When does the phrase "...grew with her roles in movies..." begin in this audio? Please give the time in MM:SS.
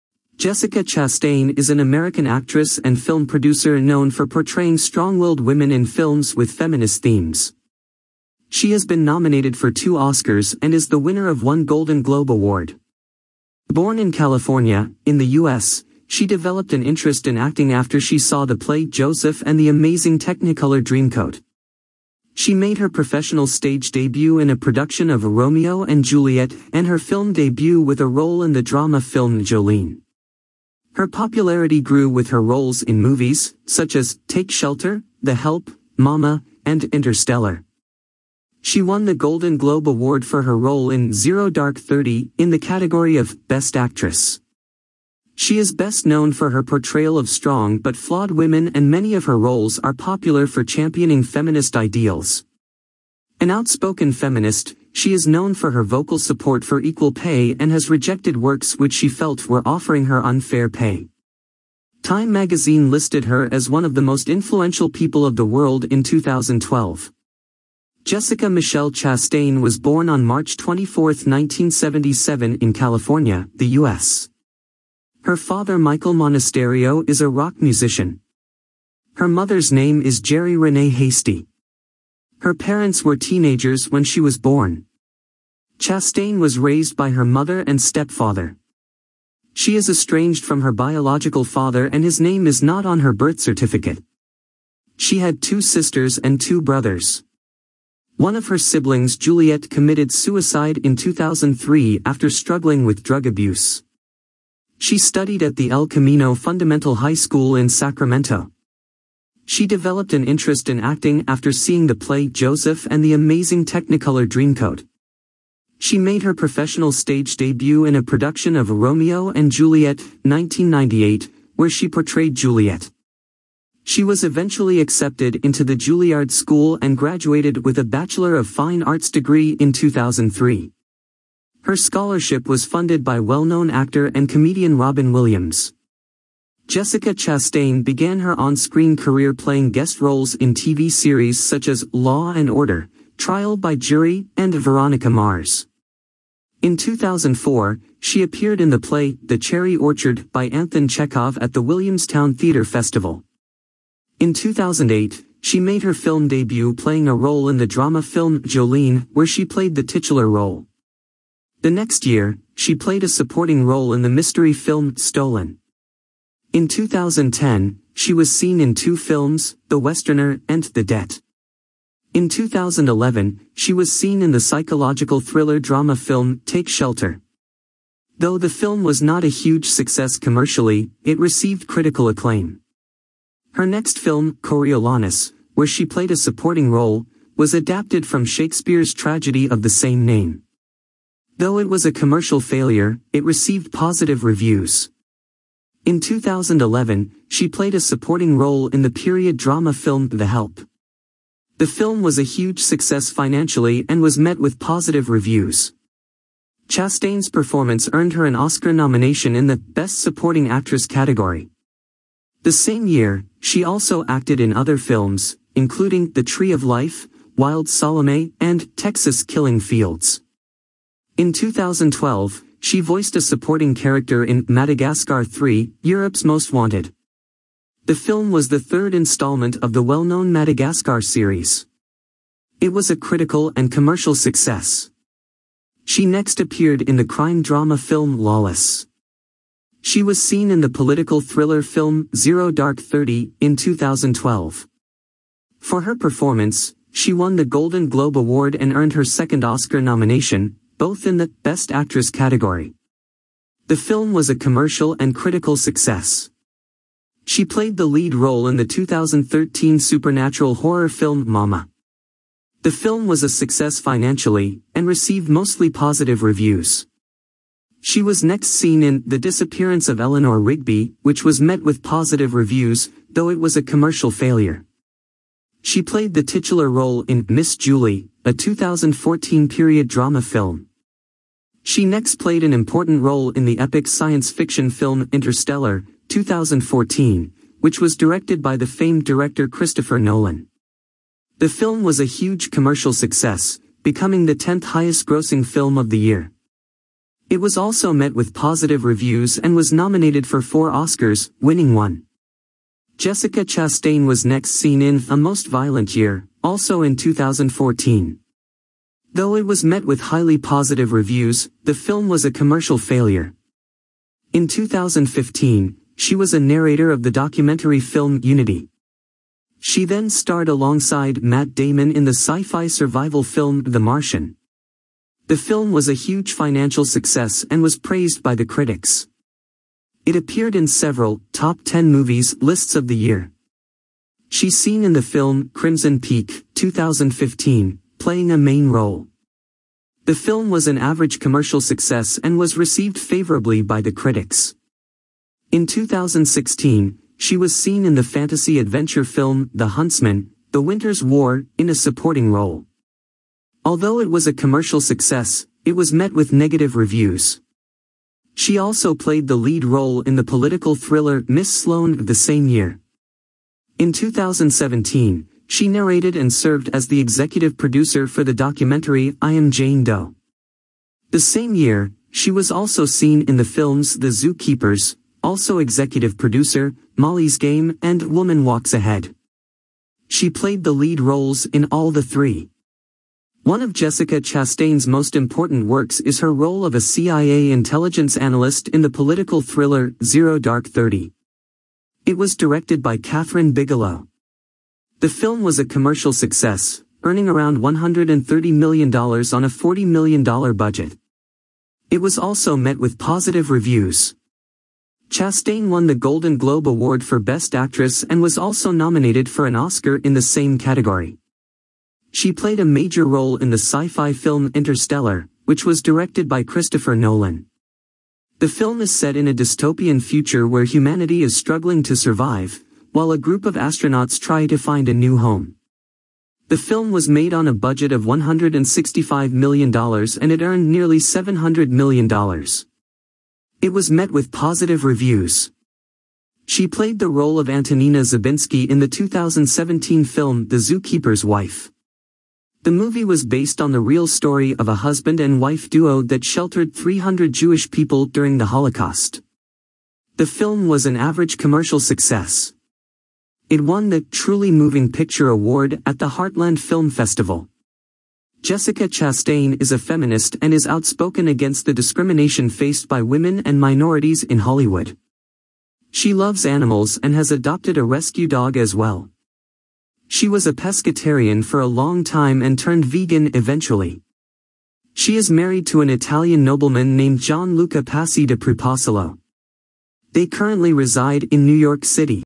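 00:31.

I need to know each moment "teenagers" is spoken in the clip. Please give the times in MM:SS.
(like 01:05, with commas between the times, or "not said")
01:23.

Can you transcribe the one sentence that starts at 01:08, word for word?
Jessica Michelle Chastain was born on March 24, 1977 in California, the U.S.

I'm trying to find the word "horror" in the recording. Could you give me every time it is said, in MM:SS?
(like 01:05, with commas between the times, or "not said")
04:20.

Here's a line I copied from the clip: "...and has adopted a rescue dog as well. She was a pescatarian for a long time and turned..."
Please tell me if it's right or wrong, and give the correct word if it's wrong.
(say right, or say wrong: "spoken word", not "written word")
right.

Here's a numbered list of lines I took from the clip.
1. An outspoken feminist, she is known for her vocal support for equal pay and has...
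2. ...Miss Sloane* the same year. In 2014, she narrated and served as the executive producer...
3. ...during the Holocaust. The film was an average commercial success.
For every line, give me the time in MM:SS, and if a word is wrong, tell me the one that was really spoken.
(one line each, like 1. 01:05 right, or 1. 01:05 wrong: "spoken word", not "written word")
1. 00:53 right
2. 06:01 wrong: "2017", not "2014"
3. 07:28 right.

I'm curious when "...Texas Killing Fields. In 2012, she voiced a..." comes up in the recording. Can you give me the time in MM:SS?
03:38.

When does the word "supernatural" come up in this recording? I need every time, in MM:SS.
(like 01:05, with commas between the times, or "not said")
04:19.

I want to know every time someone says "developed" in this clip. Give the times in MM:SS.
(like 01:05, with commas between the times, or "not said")
00:16, 01:49.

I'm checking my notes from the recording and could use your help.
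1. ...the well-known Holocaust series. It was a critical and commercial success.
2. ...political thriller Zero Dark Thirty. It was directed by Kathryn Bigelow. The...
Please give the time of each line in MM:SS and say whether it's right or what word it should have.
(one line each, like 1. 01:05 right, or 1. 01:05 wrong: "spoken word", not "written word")
1. 03:49 wrong: "Madagascar", not "Holocaust"
2. 06:28 right.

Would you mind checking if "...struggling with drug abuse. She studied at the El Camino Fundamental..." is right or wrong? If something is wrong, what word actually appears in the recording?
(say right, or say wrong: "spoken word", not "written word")
right.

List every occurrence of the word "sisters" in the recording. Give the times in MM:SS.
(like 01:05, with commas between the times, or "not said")
01:35.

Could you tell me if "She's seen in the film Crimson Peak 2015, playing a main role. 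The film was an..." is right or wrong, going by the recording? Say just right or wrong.
right.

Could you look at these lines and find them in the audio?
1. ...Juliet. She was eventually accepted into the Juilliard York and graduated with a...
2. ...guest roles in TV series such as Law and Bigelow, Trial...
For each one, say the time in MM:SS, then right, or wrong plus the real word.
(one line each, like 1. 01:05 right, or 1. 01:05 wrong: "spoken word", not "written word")
1. 02:02 wrong: "School", not "York"
2. 02:19 wrong: "Order", not "Bigelow".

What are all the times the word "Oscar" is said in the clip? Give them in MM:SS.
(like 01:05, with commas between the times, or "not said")
00:09, 03:28, 04:09, 05:00, 06:49.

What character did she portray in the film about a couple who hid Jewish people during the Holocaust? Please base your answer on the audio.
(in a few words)
Antonina Zabinsky.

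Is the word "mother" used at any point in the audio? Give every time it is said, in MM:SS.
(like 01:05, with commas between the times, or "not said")
01:19, 01:27.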